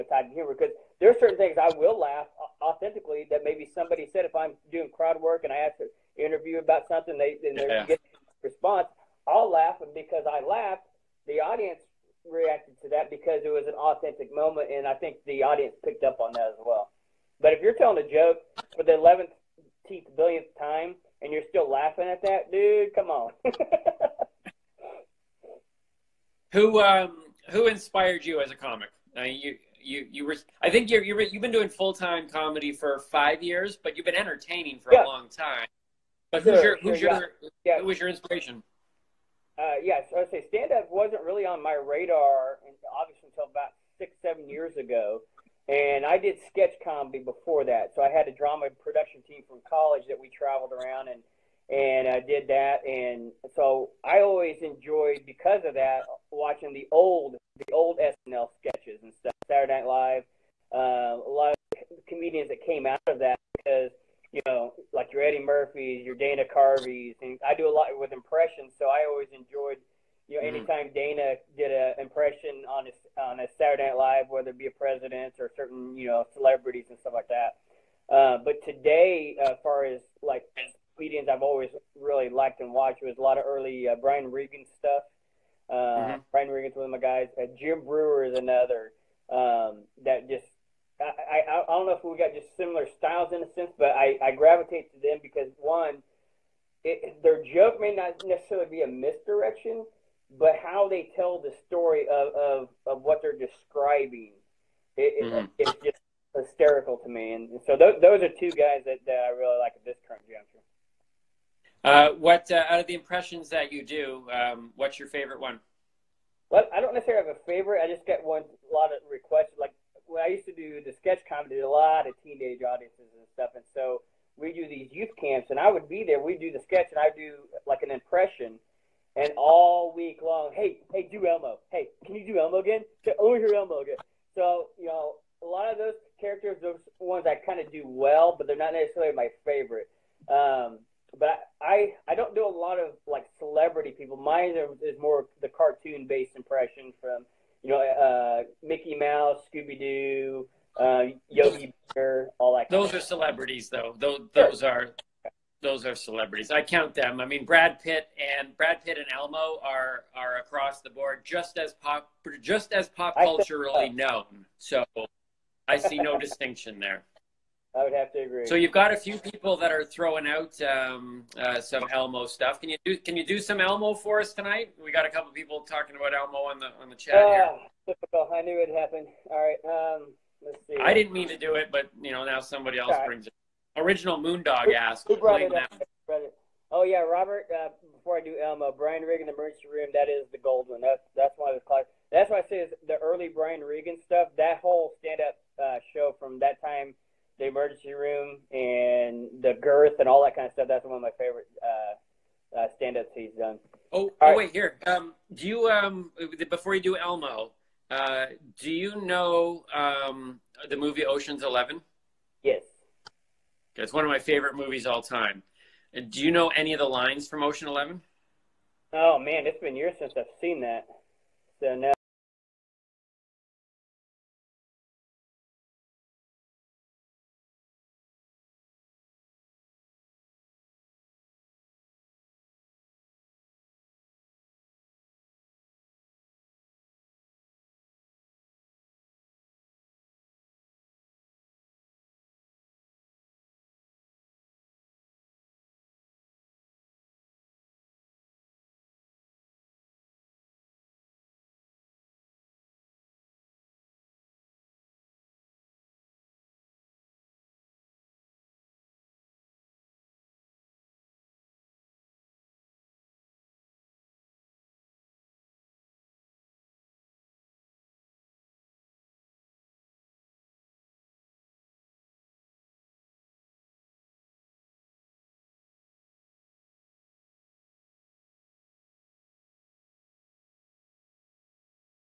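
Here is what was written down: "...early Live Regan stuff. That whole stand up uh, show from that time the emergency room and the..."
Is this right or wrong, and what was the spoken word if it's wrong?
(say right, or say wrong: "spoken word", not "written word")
wrong: "Brian", not "Live".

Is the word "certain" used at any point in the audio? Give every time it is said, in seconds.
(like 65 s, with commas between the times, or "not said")
1 s, 75 s.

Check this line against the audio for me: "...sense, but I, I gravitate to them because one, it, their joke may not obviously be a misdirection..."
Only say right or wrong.
wrong.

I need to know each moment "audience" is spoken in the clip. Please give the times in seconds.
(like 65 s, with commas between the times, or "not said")
11 s, 15 s, 122 s.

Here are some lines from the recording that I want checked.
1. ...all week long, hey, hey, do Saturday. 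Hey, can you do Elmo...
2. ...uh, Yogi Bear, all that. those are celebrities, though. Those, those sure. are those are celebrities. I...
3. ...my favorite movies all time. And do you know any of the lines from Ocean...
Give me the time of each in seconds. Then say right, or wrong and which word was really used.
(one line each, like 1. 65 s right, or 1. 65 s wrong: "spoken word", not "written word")
1. 129 s wrong: "Elmo", not "Saturday"
2. 150 s right
3. 214 s right.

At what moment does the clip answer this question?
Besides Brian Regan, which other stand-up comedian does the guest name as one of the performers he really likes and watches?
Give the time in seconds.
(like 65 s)
87 s.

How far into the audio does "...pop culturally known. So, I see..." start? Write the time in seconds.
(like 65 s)
162 s.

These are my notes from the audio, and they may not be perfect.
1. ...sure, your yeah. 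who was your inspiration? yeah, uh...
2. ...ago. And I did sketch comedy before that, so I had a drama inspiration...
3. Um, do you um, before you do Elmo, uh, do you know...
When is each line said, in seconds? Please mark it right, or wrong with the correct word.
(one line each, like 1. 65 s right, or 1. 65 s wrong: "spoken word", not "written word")
1. 36 s right
2. 44 s wrong: "production", not "inspiration"
3. 204 s right.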